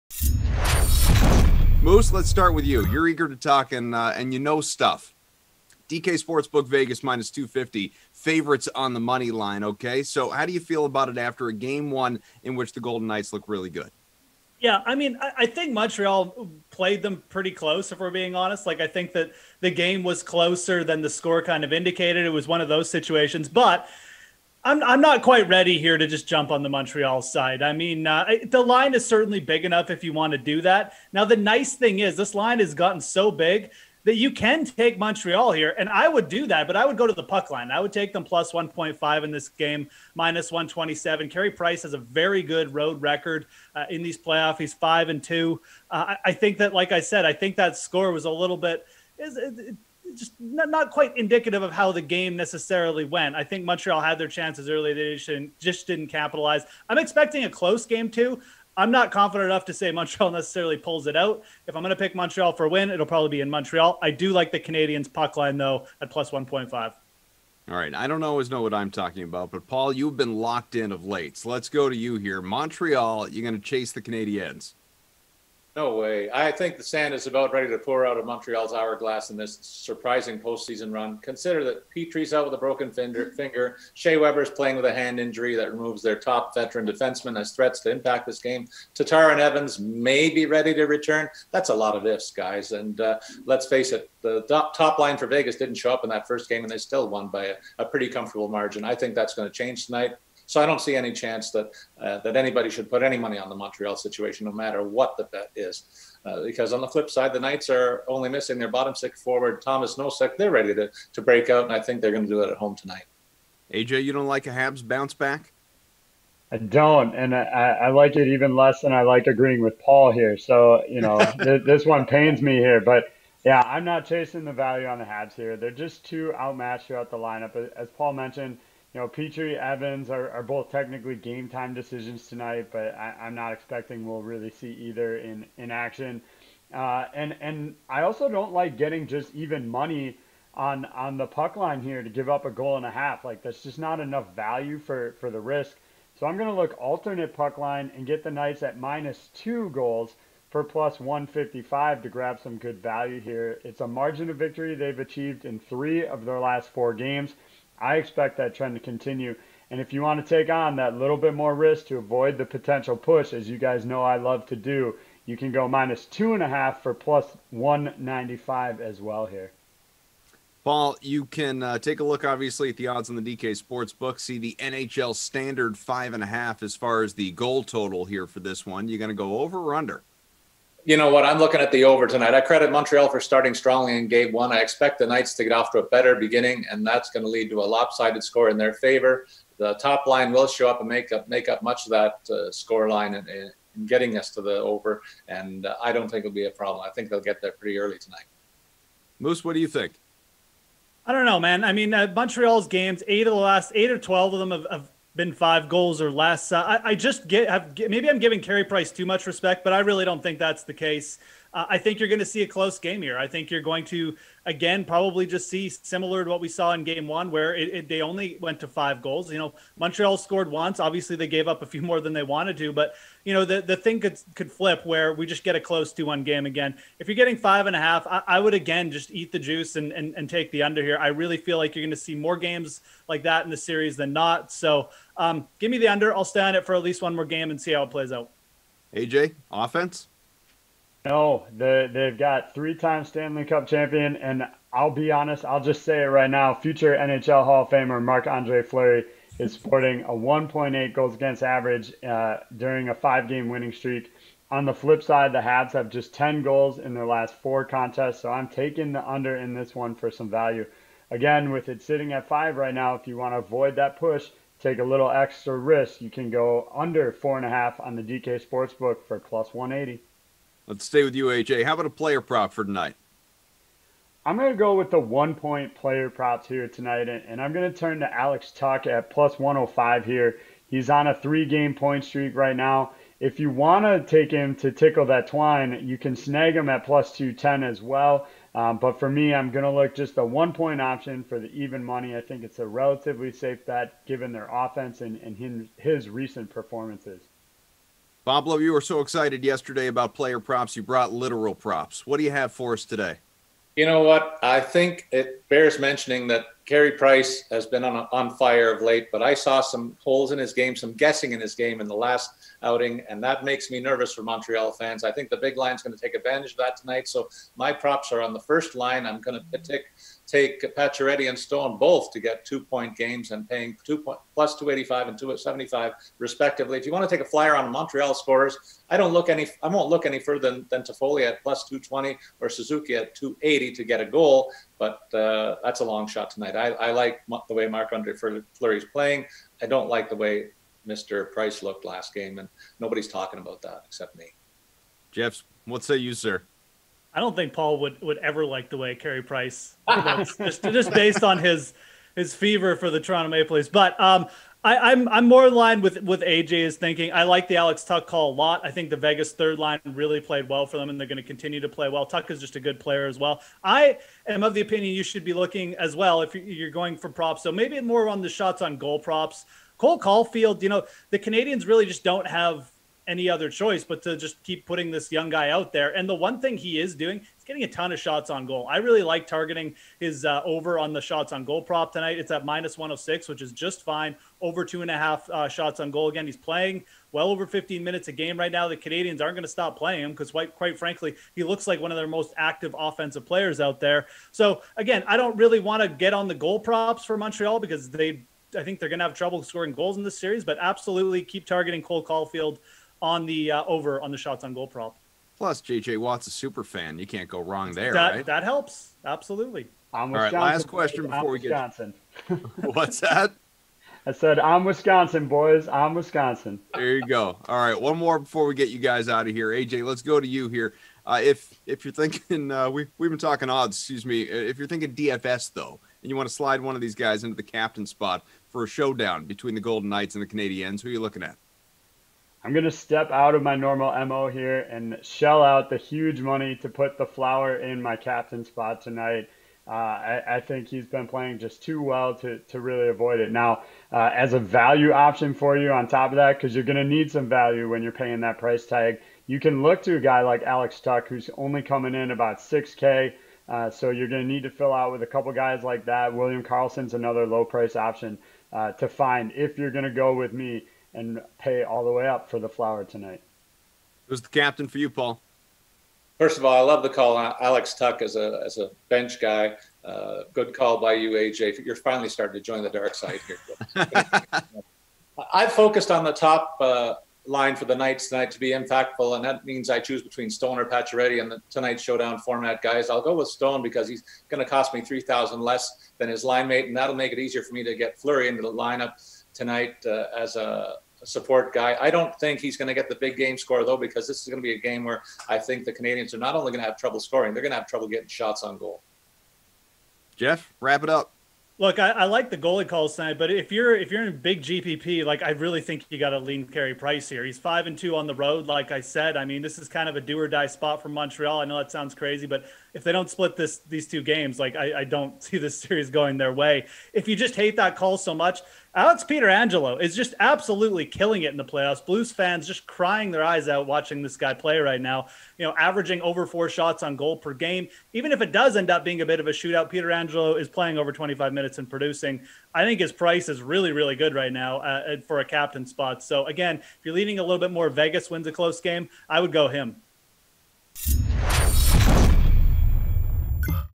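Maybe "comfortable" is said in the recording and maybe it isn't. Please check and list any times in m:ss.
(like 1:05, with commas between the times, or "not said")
1:38.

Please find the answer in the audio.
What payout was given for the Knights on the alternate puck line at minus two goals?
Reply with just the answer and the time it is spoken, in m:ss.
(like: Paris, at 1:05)
+155, at 2:30.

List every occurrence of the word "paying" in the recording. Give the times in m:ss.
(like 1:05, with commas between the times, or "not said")
5:23, 7:27.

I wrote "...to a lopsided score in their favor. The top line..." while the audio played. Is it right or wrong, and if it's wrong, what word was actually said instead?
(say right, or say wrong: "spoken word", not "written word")
right.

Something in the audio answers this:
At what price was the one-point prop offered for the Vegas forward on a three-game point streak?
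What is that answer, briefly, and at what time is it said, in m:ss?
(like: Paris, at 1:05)
+105, at 4:39.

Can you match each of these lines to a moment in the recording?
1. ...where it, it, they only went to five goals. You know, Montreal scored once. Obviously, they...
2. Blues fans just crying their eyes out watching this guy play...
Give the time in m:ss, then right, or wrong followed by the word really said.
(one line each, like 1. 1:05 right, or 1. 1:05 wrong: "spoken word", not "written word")
1. 3:37 right
2. 8:41 right.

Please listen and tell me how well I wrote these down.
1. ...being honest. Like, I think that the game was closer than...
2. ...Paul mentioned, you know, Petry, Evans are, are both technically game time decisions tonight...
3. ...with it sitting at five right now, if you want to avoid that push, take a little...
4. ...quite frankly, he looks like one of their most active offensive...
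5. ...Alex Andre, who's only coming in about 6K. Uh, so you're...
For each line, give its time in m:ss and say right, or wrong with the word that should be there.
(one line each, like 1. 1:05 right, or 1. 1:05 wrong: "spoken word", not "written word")
1. 0:18 right
2. 2:07 right
3. 4:21 right
4. 6:30 right
5. 7:30 wrong: "Tuch", not "Andre".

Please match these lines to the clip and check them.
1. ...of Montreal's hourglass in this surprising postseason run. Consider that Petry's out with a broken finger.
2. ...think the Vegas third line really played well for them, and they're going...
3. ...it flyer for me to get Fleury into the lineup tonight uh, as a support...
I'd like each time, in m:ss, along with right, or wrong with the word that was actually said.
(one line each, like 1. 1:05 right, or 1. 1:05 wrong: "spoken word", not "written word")
1. 1:18 right
2. 5:58 right
3. 8:07 wrong: "easier", not "flyer".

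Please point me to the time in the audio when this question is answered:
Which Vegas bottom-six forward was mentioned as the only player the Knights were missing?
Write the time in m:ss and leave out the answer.
1:49.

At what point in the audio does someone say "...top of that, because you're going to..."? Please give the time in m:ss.
7:25.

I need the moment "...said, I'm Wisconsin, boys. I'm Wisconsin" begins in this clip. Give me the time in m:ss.
6:54.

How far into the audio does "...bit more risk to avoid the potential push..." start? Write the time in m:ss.
2:41.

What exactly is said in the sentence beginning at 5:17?
So my props are on the first line.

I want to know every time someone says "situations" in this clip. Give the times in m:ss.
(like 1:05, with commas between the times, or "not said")
0:22, 1:43.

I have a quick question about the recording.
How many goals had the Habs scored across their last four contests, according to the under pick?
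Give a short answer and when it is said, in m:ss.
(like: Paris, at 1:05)
10, at 4:16.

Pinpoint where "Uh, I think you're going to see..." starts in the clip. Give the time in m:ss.
3:31.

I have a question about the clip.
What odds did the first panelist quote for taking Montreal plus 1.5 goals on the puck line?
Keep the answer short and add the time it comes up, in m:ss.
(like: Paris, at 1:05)
-127, at 0:40.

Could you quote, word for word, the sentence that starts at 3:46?
If you're getting five and a half, I, I would, again, just eat the juice and, and, and take the under here.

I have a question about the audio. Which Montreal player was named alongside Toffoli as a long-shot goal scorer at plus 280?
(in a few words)
Suzuki.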